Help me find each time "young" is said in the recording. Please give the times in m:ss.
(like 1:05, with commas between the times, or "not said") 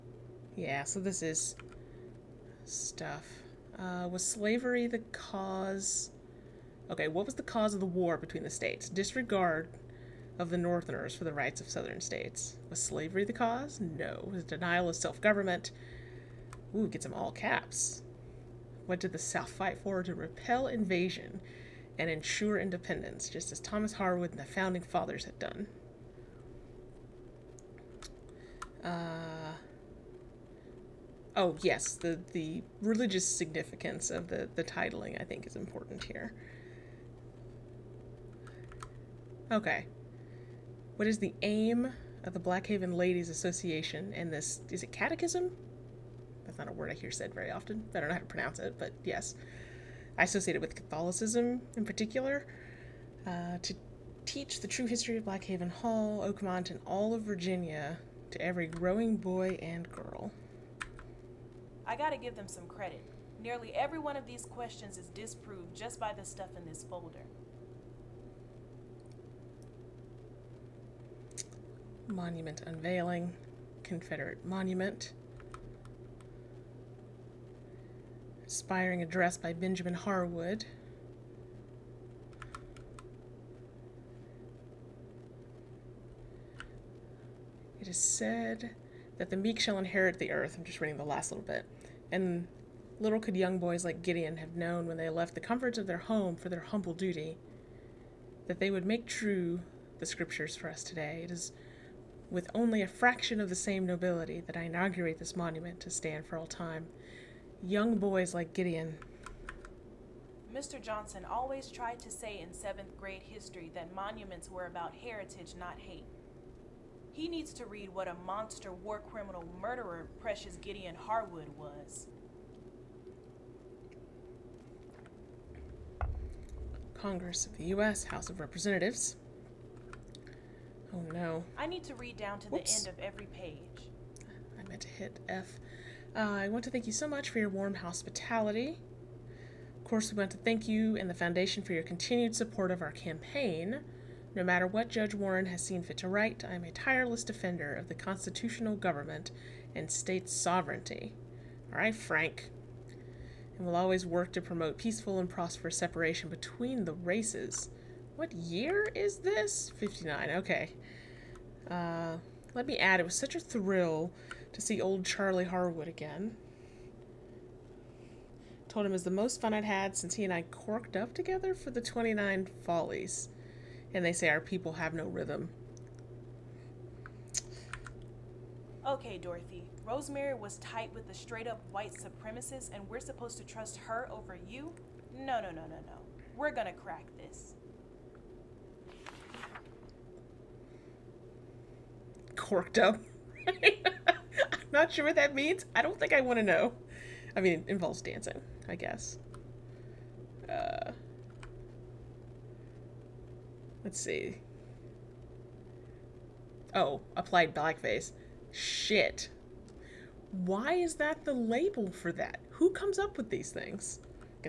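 1:33, 1:47.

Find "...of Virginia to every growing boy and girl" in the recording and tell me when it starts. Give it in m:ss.
0:57.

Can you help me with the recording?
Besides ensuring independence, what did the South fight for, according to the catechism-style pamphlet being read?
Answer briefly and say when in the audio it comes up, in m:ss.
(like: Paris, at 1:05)
To repel invasion, at 0:20.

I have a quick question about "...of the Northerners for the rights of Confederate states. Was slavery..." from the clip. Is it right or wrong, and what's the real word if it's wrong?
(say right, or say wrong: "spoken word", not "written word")
wrong: "Southern", not "Confederate".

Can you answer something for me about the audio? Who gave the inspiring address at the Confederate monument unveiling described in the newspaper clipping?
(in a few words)
Benjamin Harwood.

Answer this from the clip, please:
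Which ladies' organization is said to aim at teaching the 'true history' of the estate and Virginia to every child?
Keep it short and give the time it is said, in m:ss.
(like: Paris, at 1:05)
Blackhaven Ladies Association, at 0:42.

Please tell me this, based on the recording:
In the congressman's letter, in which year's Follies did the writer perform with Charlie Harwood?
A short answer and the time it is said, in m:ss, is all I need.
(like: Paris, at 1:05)
29, at 2:51.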